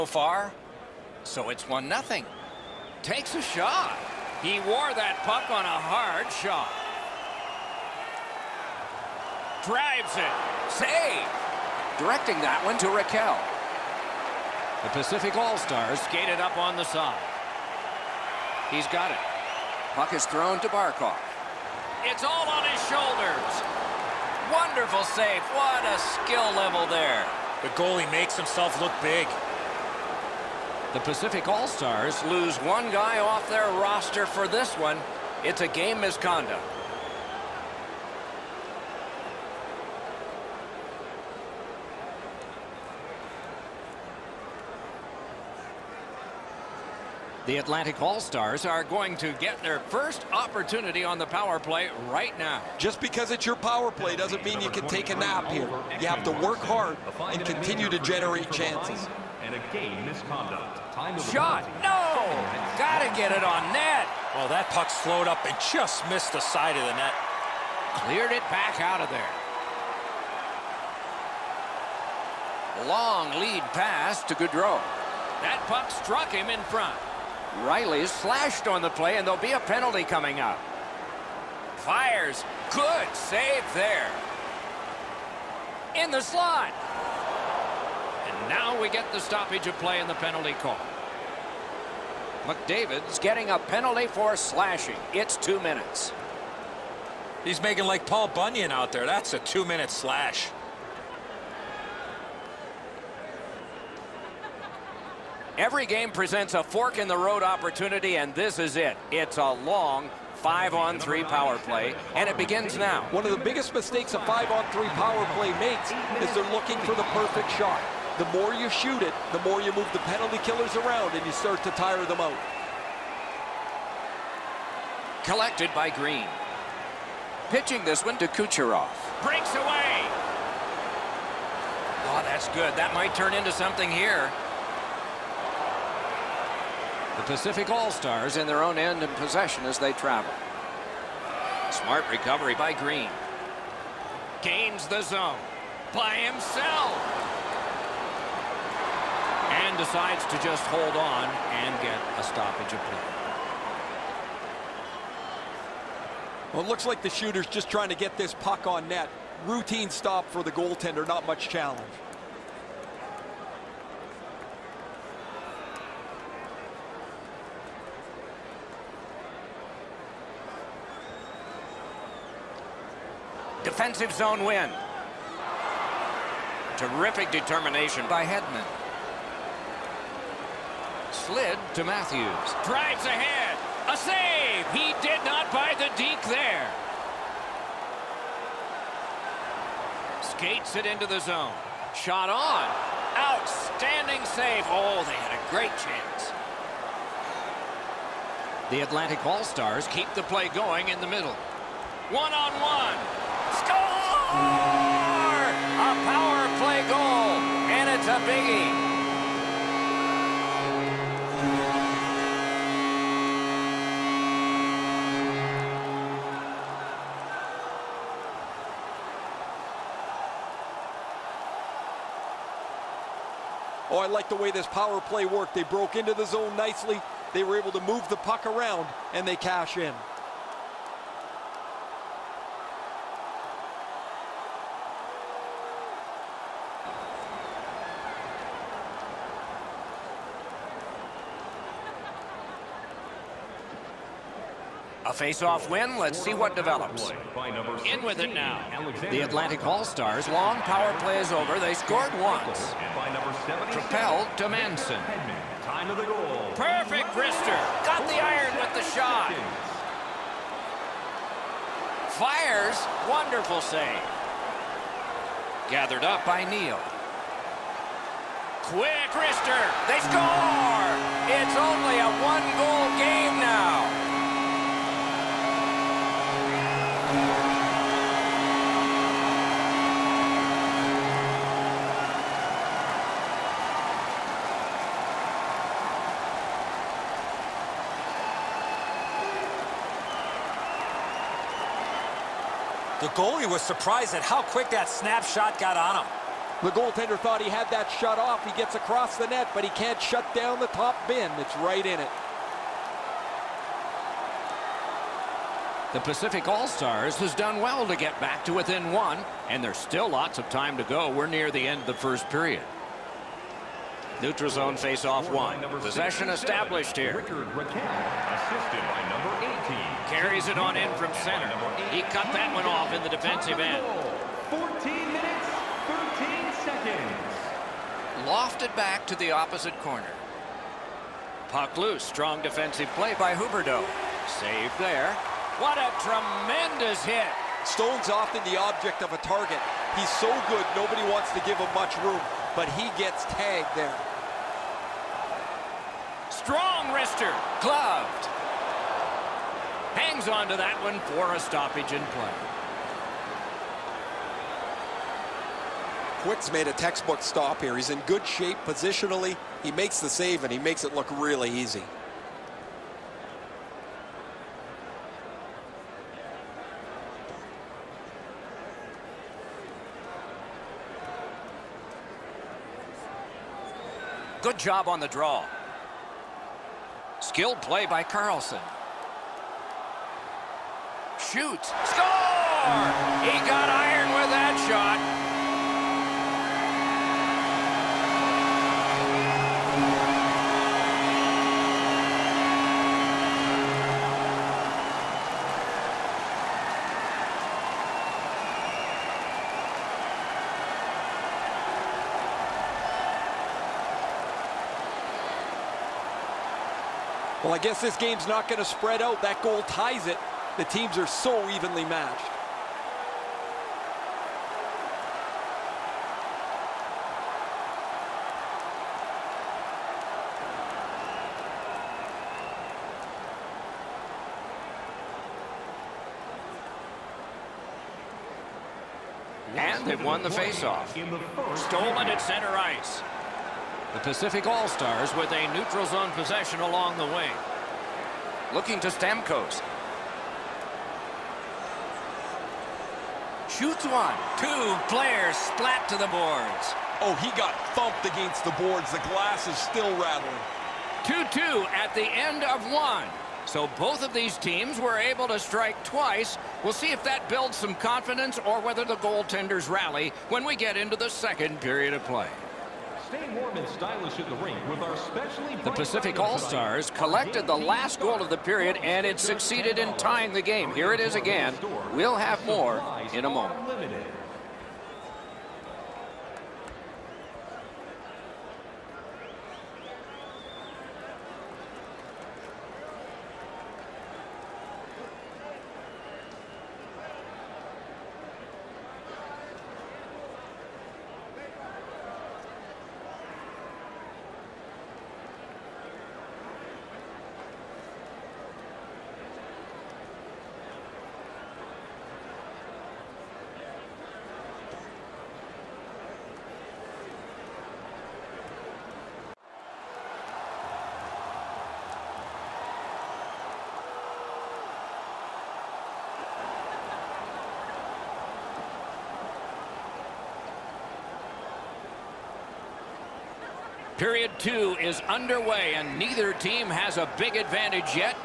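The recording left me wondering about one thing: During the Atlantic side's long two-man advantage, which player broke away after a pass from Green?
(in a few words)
Kucherov.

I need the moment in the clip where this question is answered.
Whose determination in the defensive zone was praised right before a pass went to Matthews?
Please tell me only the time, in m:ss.
2:58.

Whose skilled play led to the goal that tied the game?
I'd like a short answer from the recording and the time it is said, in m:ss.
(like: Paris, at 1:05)
Carlson, at 6:18.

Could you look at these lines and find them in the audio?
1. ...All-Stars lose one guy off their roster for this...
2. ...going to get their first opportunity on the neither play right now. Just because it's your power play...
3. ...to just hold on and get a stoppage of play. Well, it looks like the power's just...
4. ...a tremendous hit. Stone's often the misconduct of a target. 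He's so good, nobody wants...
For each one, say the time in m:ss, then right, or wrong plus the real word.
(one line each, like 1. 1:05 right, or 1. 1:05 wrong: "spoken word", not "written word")
1. 0:31 right
2. 0:48 wrong: "power", not "neither"
3. 2:30 wrong: "shooter", not "power"
4. 5:35 wrong: "object", not "misconduct".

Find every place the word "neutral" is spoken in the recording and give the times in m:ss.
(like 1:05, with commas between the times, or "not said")
5:14, 7:15.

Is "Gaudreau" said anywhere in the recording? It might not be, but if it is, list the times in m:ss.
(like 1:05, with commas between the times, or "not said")
1:14.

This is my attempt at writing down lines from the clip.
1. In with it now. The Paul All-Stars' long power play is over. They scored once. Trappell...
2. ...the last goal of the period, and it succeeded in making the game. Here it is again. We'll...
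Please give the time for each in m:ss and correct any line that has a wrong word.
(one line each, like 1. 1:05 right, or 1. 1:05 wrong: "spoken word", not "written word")
1. 4:07 wrong: "Atlantic", not "Paul"
2. 7:47 wrong: "tying", not "making".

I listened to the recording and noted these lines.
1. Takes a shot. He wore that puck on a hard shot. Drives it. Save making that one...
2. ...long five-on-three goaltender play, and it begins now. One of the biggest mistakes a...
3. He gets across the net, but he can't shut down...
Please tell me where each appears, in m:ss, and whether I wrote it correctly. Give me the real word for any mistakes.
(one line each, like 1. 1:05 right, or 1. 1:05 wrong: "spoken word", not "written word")
1. 0:03 wrong: "directing", not "making"
2. 1:49 wrong: "power", not "goaltender"
3. 4:58 right.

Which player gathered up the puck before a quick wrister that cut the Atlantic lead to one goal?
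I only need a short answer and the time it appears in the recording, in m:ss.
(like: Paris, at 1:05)
Neal, at 4:26.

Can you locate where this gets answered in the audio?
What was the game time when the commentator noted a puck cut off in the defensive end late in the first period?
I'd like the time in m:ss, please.
5:24.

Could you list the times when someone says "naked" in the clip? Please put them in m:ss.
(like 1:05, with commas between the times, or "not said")
not said.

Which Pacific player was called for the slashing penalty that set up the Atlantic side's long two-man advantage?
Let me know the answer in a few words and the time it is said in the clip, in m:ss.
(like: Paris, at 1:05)
McDavid, at 1:32.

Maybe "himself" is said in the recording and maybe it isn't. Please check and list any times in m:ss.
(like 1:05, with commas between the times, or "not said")
0:28, 2:26.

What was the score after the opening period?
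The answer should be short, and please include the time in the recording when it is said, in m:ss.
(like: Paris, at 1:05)
2-2, at 7:31.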